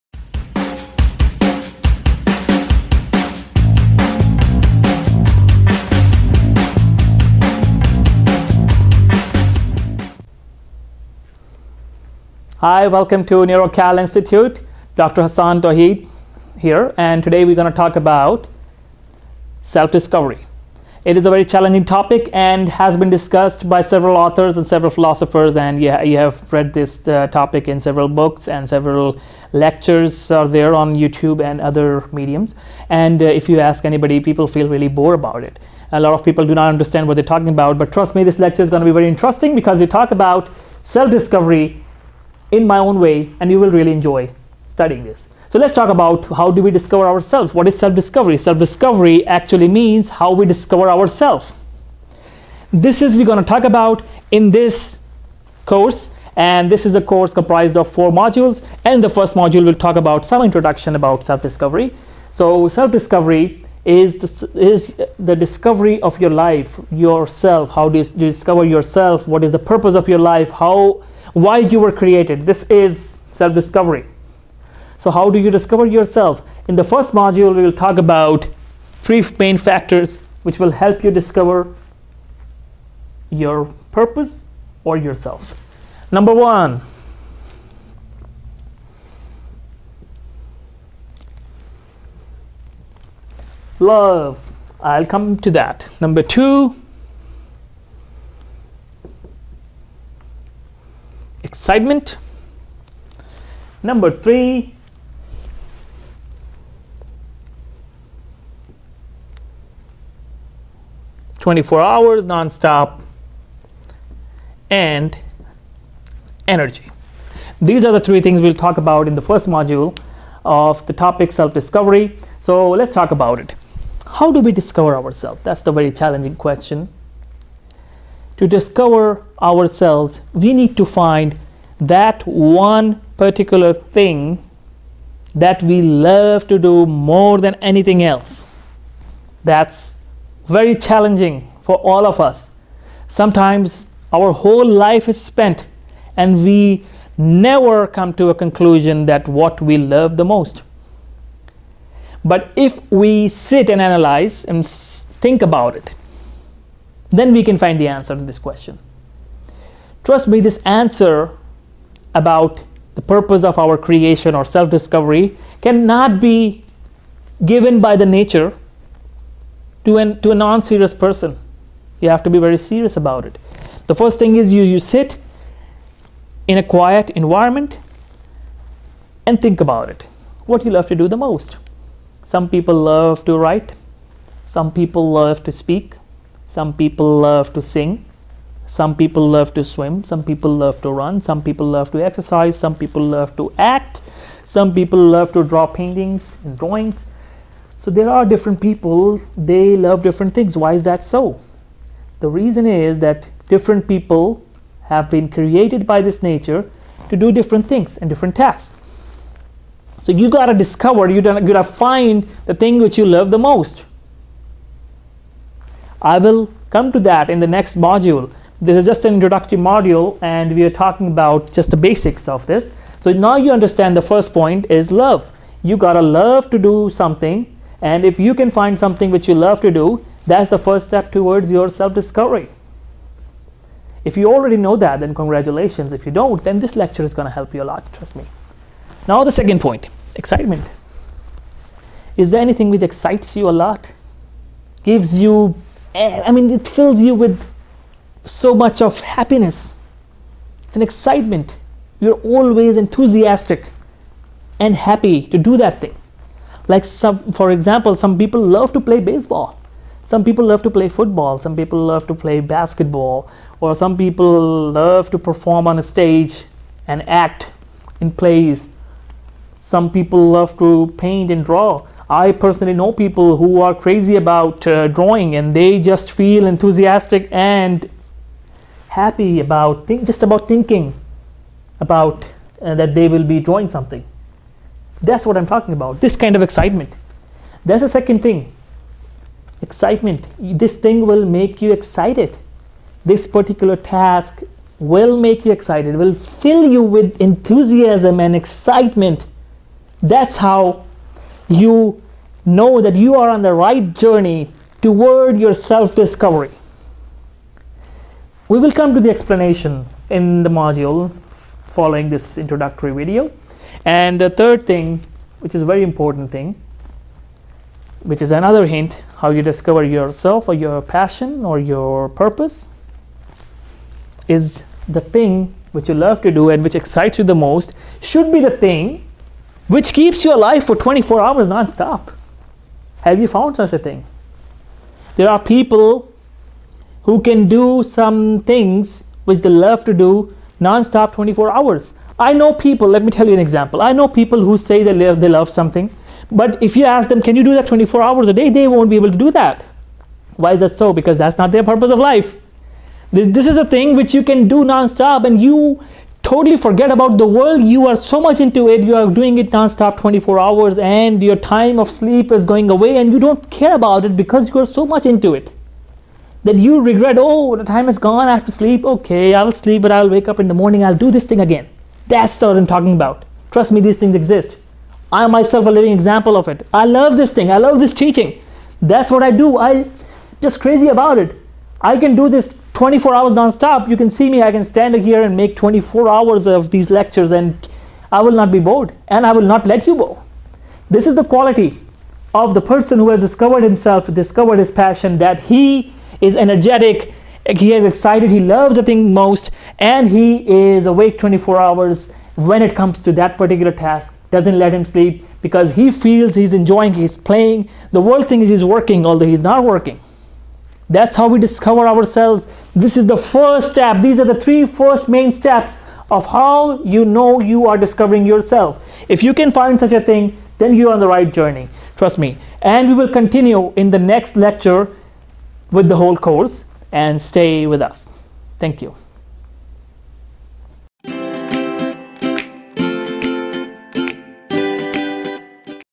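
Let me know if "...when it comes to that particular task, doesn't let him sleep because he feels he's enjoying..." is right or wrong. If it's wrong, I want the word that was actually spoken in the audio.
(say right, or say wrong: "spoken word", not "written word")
right.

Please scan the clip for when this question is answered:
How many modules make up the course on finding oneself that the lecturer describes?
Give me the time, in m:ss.
0:57.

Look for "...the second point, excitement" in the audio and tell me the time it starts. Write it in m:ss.
3:59.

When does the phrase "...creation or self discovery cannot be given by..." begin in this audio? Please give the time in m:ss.
2:43.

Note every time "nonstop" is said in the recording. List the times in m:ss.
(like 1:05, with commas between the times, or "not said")
5:31, 5:40, 5:54.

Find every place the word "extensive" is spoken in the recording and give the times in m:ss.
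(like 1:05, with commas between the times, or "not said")
not said.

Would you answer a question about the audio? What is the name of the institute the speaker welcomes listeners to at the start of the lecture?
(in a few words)
NeuroCal Institute.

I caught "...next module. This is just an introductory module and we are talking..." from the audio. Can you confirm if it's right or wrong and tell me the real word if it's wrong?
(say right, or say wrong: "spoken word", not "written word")
right.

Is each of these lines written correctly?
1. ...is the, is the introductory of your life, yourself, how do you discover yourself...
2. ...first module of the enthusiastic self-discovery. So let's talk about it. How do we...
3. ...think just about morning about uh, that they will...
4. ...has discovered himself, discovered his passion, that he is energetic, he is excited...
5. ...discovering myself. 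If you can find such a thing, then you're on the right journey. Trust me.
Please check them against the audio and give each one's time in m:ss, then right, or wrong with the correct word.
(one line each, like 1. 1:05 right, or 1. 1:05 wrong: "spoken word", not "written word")
1. 1:03 wrong: "discovery", not "introductory"
2. 1:59 wrong: "topic", not "enthusiastic"
3. 4:39 wrong: "thinking", not "morning"
4. 6:33 right
5. 6:57 wrong: "yourself", not "myself".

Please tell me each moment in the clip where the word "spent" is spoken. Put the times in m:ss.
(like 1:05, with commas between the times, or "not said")
2:25.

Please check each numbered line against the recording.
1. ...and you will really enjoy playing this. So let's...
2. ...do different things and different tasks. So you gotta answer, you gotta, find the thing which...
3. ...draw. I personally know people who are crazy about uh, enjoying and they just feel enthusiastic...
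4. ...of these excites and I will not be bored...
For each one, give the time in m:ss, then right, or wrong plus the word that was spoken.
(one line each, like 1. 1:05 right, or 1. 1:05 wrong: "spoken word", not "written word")
1. 0:43 wrong: "studying", not "playing"
2. 3:27 wrong: "discover", not "answer"
3. 4:31 wrong: "drawing", not "enjoying"
4. 6:26 wrong: "lectures", not "excites".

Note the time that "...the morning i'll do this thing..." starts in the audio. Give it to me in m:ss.
6:10.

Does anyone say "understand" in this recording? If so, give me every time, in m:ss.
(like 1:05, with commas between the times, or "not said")
0:36, 3:43.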